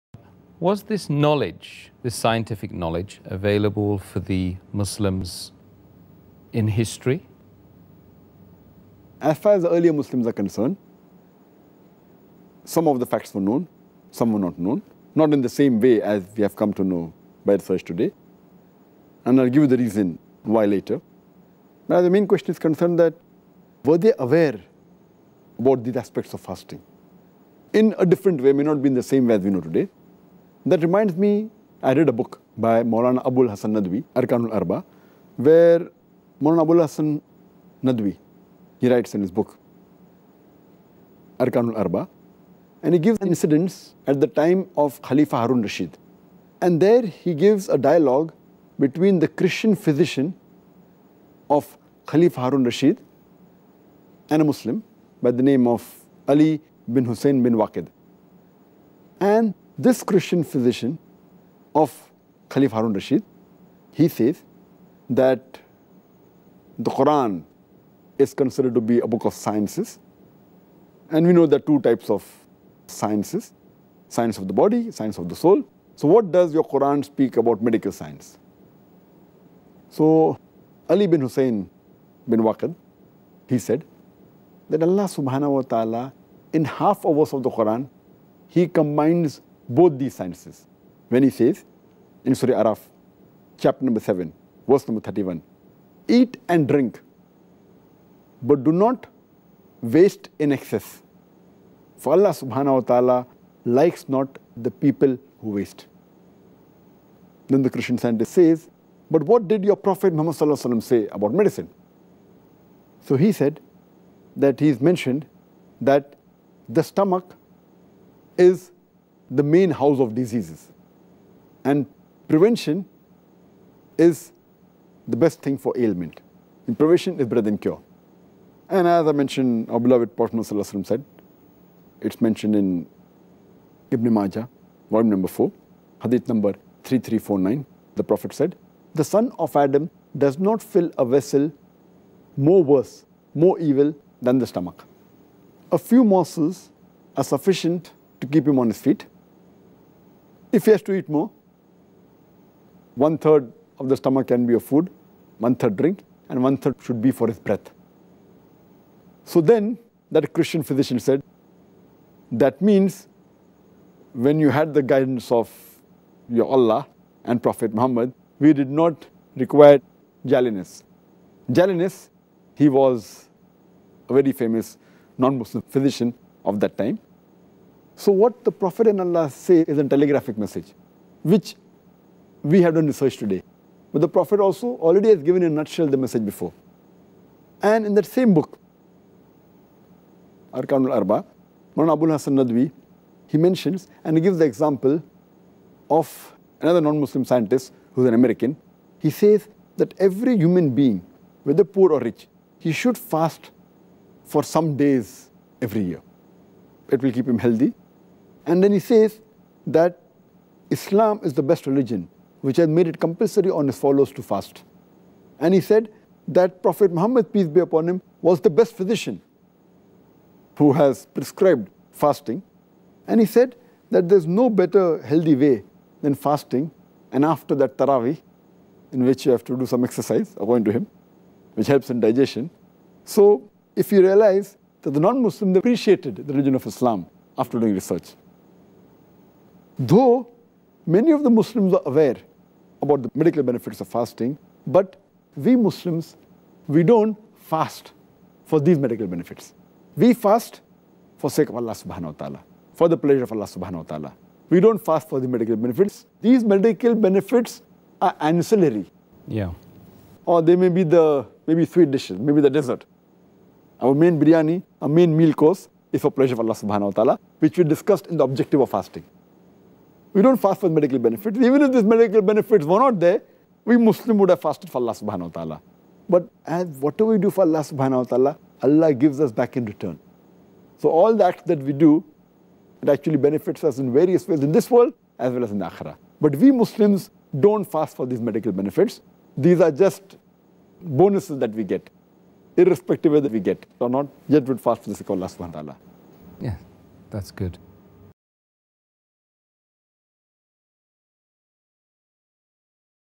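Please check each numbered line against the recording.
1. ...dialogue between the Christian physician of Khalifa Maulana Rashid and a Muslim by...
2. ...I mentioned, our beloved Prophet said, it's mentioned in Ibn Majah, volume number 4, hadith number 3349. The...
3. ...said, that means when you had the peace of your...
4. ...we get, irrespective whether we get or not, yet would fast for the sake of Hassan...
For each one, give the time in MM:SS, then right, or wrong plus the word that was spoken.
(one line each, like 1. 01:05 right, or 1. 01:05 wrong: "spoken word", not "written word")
1. 00:47 wrong: "Harun", not "Maulana"
2. 02:09 right
3. 02:40 wrong: "guidance", not "peace"
4. 04:51 wrong: "Allah", not "Hassan".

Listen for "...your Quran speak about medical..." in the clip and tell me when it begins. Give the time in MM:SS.
01:16.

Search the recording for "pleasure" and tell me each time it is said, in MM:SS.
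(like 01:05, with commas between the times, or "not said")
04:12, 04:26.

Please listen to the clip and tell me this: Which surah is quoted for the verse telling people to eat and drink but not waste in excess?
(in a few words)
Surah Araf.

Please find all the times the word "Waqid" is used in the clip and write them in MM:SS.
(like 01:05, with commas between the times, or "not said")
00:57, 01:22.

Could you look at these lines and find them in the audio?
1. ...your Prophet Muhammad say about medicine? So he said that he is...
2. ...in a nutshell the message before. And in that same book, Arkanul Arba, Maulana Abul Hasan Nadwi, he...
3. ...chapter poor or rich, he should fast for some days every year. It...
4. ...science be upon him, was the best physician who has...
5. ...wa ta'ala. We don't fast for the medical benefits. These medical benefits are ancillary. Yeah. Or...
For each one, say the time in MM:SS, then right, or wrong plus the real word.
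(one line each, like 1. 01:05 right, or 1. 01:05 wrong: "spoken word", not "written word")
1. 01:49 right
2. 03:05 right
3. 03:21 wrong: "whether", not "chapter"
4. 03:37 wrong: "peace", not "science"
5. 04:13 right.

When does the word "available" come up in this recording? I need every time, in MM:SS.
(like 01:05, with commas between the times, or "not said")
00:03.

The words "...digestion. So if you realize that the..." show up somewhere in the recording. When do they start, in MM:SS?
03:51.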